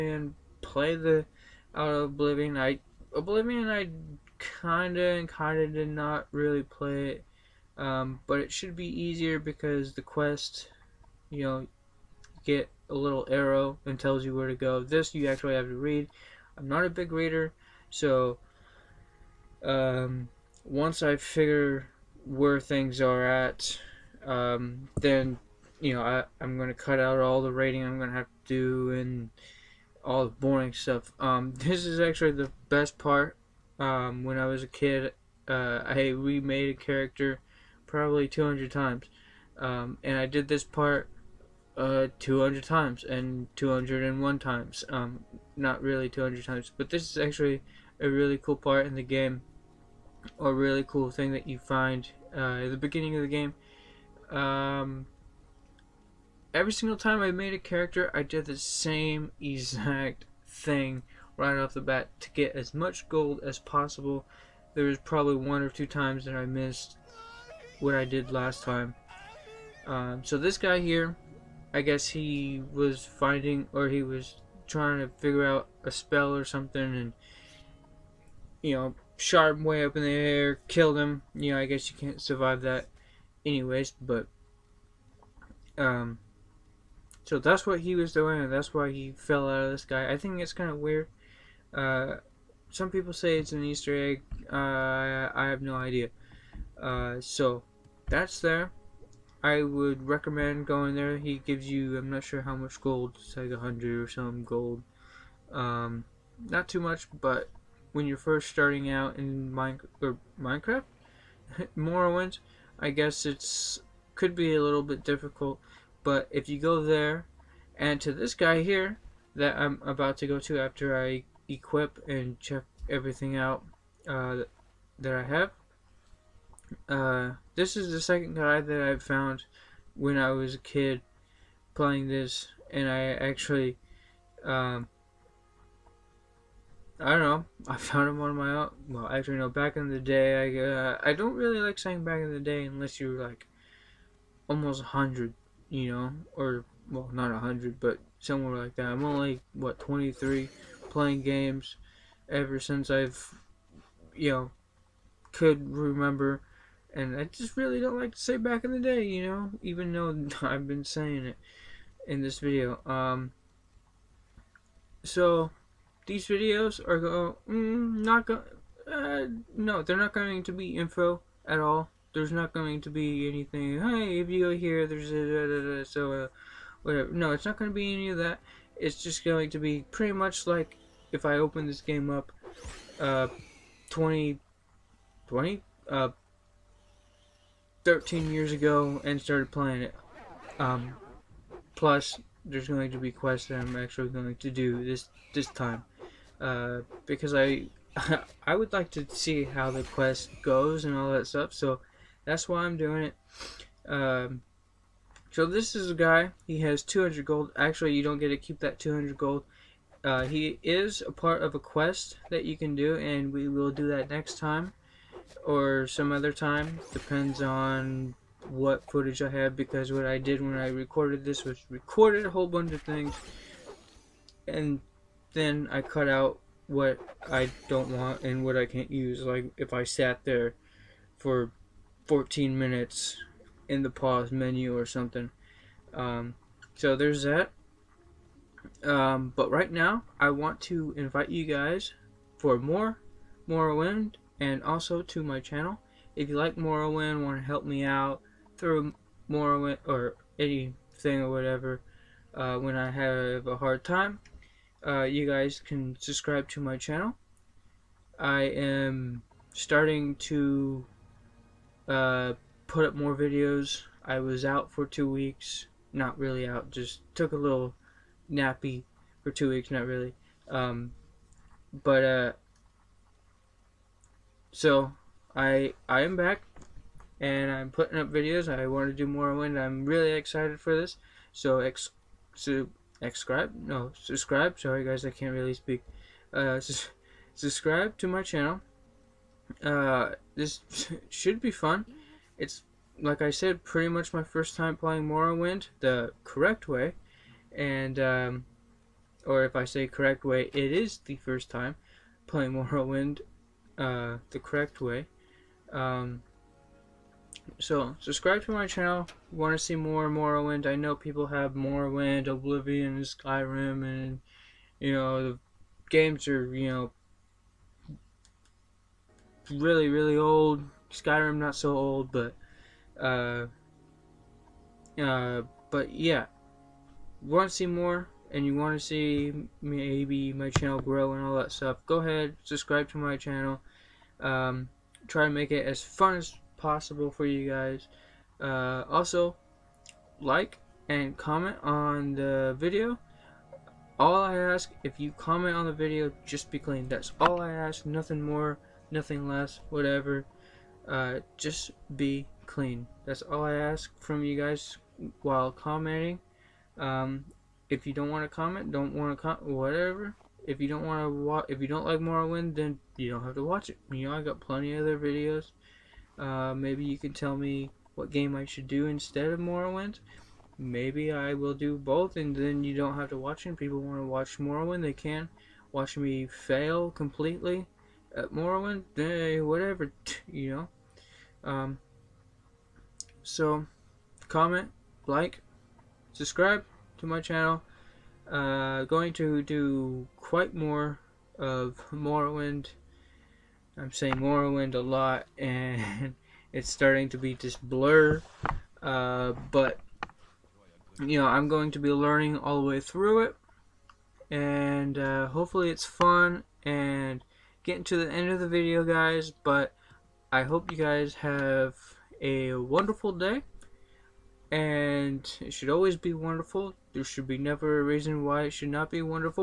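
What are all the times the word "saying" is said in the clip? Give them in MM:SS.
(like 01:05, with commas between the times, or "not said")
02:21, 02:40, 06:33.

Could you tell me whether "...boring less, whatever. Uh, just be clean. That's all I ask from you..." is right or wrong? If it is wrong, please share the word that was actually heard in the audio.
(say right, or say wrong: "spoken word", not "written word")
wrong: "nothing", not "boring".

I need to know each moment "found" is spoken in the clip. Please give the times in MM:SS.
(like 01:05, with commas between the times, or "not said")
02:08, 02:17.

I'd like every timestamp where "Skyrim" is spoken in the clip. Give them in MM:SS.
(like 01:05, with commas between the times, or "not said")
05:13, 05:20.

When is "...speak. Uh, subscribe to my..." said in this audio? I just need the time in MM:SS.
04:45.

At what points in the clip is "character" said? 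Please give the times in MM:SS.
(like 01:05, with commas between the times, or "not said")
00:36, 00:57.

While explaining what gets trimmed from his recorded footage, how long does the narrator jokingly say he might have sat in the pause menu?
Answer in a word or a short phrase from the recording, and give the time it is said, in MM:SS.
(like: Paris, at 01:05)
14 minutes, at 03:52.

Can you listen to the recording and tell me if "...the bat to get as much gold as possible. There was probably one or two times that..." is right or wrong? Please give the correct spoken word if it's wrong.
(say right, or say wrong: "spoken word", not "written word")
right.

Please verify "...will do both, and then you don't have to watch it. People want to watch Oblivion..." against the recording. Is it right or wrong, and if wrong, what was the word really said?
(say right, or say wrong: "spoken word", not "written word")
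wrong: "Morrowind", not "Oblivion".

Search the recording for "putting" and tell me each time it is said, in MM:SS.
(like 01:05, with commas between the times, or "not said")
04:37.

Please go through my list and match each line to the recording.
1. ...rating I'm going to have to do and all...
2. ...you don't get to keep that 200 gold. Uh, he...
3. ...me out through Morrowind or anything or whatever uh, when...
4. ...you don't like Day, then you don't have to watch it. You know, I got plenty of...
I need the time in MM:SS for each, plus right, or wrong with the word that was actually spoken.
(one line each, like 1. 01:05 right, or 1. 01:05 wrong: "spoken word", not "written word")
1. 00:27 right
2. 03:27 right
3. 04:07 right
4. 06:01 wrong: "Morrowind", not "Day".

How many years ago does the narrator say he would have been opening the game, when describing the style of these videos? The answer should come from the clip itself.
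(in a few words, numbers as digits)
13.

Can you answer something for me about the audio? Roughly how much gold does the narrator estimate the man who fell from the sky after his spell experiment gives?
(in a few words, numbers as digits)
100.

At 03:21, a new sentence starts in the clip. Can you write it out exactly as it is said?
So that's why I'm doing it.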